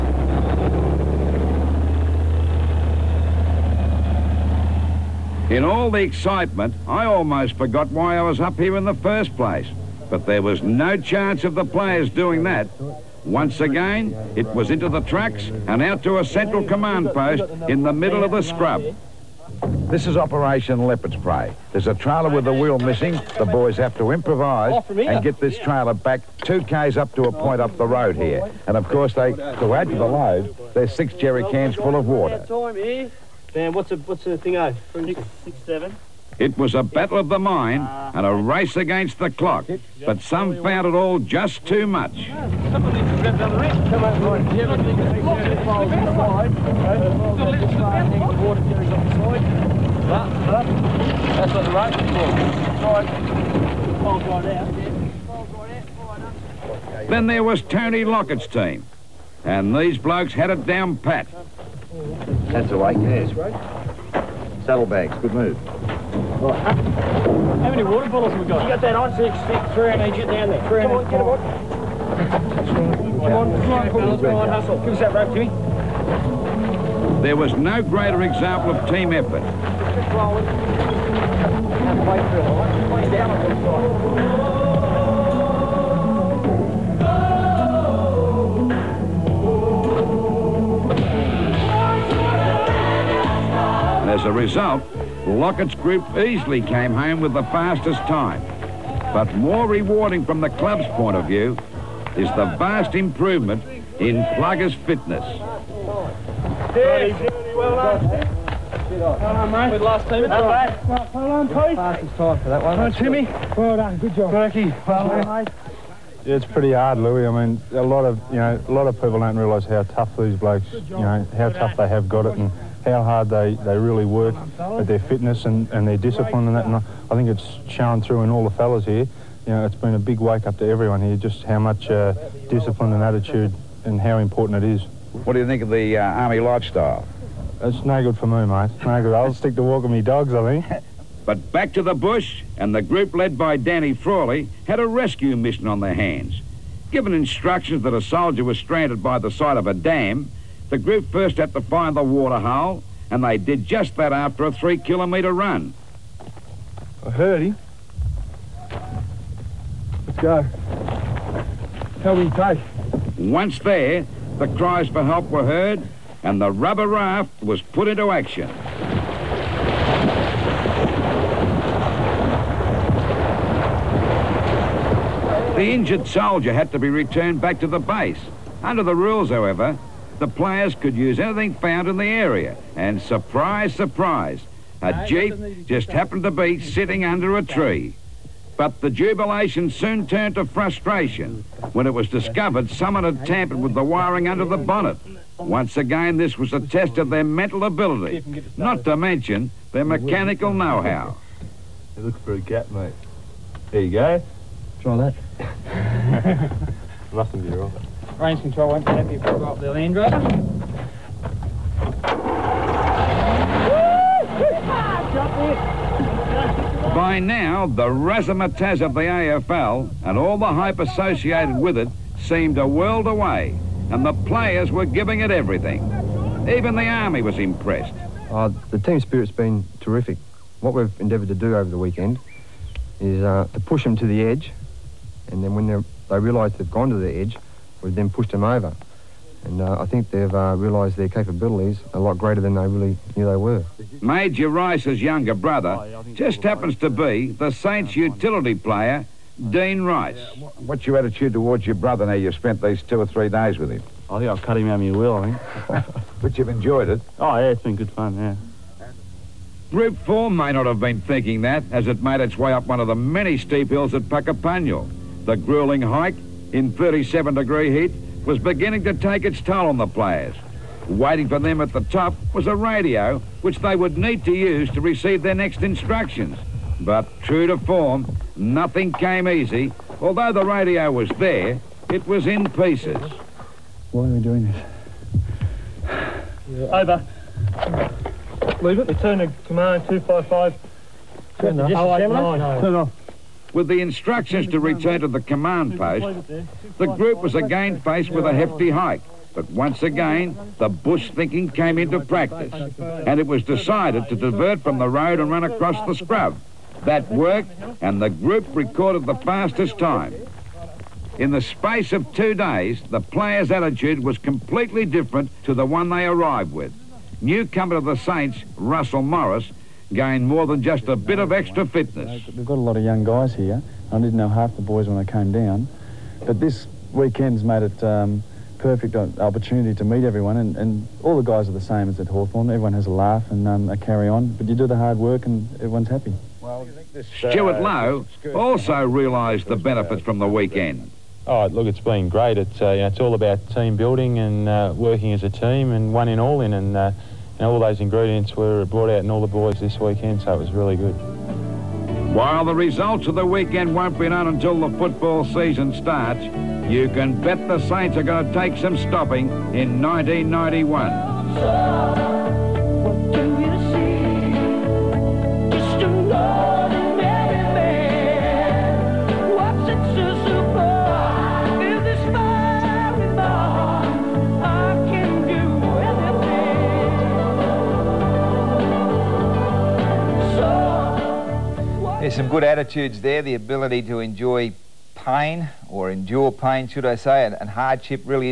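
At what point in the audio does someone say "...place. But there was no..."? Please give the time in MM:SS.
00:09.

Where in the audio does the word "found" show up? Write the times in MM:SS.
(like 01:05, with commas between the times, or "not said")
00:40, 03:01.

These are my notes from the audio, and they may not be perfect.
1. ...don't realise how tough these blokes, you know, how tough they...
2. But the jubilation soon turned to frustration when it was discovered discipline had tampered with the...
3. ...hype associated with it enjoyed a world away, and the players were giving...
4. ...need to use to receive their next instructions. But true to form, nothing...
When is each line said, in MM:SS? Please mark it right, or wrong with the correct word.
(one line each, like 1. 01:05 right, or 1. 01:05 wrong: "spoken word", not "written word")
1. 01:59 right
2. 03:08 wrong: "someone", not "discipline"
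3. 03:40 wrong: "seemed", not "enjoyed"
4. 04:33 right.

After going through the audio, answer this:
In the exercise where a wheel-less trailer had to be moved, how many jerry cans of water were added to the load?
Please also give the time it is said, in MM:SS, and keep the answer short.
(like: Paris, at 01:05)
6, at 00:30.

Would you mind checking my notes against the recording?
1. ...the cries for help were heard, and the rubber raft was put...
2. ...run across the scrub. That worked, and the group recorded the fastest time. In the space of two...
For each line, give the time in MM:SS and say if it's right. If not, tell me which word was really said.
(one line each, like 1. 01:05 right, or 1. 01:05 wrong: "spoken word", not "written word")
1. 02:44 right
2. 05:05 right.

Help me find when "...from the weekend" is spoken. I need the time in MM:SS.
05:40.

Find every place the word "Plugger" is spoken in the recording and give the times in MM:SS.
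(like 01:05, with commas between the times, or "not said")
01:44.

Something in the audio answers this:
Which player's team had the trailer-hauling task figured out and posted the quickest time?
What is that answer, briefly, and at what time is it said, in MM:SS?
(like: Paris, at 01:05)
Tony Lockett, at 00:57.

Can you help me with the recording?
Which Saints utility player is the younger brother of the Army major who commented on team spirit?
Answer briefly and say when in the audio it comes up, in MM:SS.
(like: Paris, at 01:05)
Dean Rice, at 04:09.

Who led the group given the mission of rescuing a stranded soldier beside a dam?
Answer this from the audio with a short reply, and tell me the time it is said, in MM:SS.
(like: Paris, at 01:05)
Danny Frawley, at 02:23.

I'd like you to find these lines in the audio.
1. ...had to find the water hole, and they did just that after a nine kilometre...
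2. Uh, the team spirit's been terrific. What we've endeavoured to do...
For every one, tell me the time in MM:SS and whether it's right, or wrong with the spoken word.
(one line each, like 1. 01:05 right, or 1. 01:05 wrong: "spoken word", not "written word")
1. 02:31 wrong: "three", not "nine"
2. 03:48 right.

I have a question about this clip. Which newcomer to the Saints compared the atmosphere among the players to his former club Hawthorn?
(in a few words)
Russell Morris.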